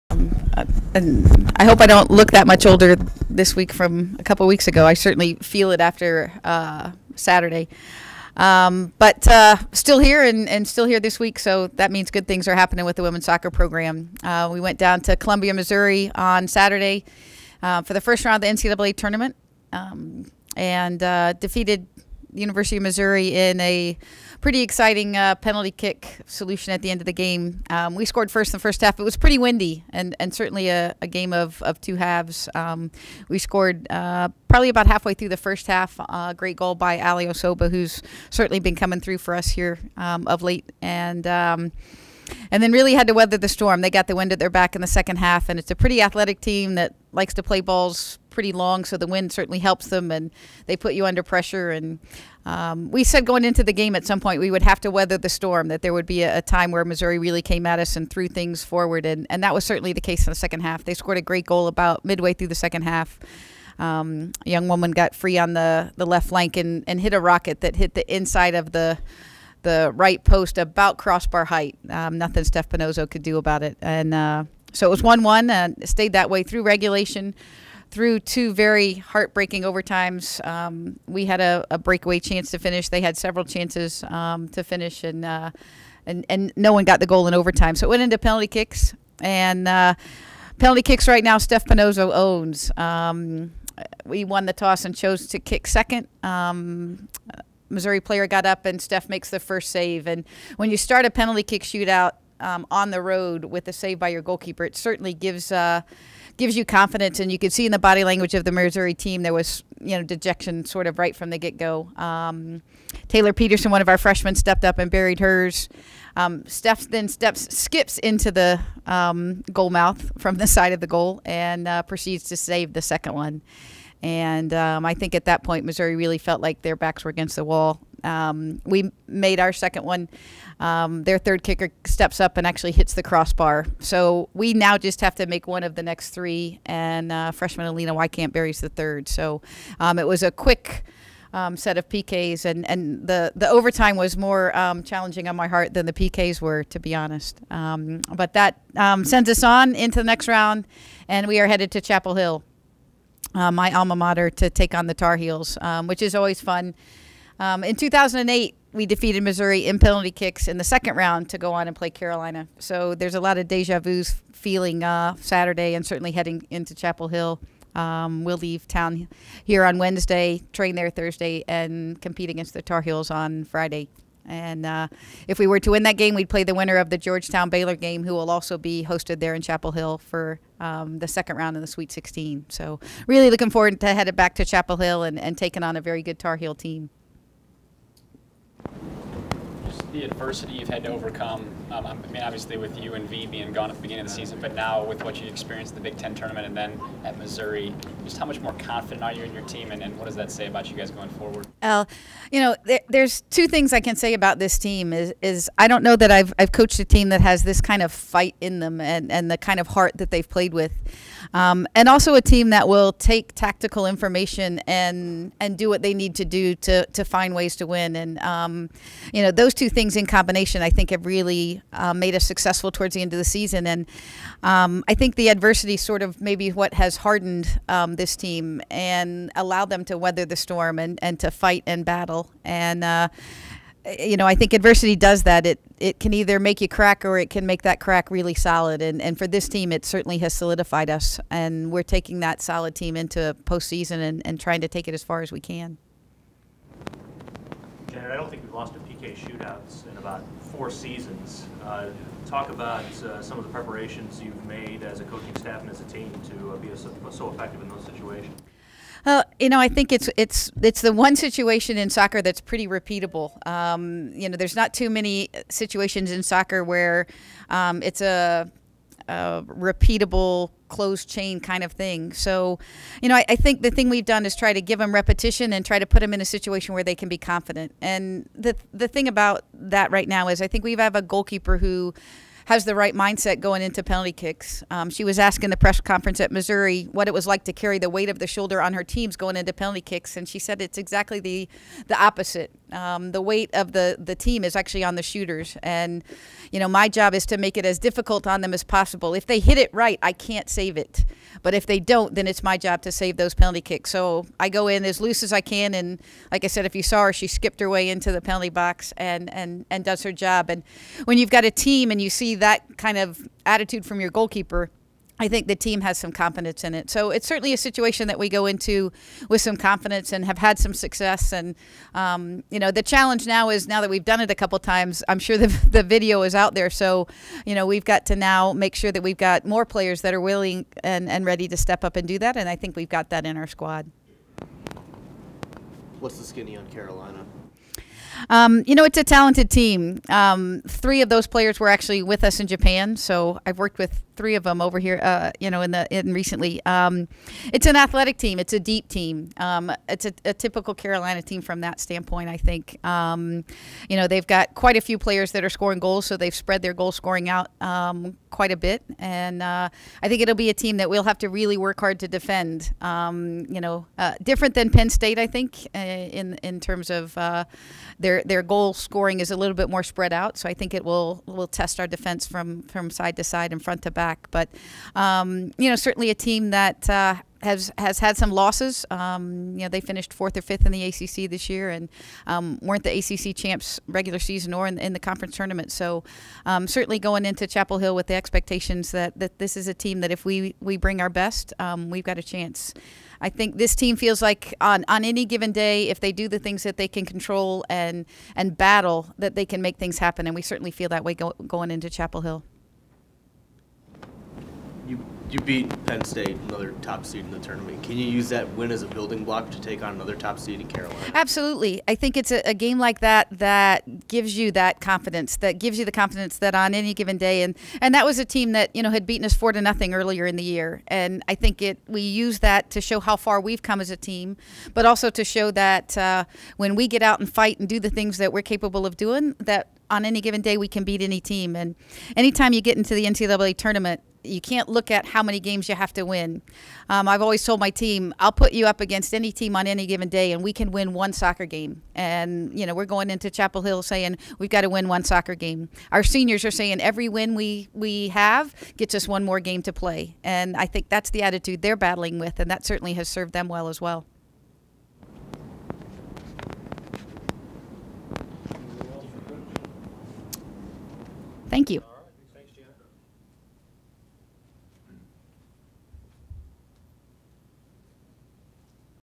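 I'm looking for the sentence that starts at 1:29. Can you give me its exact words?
And uh, penalty kicks right now, Steph Panozzo owns um, we won the toss and chose to kick second.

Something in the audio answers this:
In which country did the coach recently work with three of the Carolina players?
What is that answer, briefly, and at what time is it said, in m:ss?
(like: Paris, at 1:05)
Japan, at 5:42.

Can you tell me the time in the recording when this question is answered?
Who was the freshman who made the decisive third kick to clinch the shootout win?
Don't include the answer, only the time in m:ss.
2:17.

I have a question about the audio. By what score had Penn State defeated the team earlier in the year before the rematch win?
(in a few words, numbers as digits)
4-0.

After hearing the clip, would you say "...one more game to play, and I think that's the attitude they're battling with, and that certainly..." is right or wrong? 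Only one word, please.
right.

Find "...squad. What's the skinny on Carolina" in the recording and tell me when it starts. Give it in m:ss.
5:33.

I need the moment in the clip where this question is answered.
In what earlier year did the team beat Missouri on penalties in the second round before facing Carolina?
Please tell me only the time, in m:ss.
2:37.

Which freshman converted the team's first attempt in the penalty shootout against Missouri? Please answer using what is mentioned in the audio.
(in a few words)
Taylor Peterson.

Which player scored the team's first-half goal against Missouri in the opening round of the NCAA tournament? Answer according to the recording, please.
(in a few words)
Ali Osoba.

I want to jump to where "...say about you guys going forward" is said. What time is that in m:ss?
3:20.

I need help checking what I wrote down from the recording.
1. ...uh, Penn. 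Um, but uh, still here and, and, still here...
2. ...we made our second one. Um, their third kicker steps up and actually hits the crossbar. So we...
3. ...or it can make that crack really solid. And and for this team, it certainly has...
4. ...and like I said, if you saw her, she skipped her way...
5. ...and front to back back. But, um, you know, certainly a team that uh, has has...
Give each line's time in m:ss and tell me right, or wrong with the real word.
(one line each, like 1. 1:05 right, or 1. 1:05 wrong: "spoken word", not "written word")
1. 0:06 wrong: "Saturday", not "Penn"
2. 2:08 right
3. 3:57 right
4. 5:05 right
5. 6:13 right.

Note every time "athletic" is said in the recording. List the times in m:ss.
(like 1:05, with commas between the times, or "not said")
0:46, 5:47.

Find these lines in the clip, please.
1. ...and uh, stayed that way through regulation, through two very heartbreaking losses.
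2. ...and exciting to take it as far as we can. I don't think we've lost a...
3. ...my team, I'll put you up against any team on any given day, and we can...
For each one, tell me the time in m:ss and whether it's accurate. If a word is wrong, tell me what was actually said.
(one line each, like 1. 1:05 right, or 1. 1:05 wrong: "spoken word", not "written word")
1. 1:15 wrong: "overtimes", not "losses"
2. 4:04 wrong: "trying", not "exciting"
3. 7:17 right.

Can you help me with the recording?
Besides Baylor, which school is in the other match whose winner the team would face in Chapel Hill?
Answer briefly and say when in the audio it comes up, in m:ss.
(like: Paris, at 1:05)
Georgetown, at 2:56.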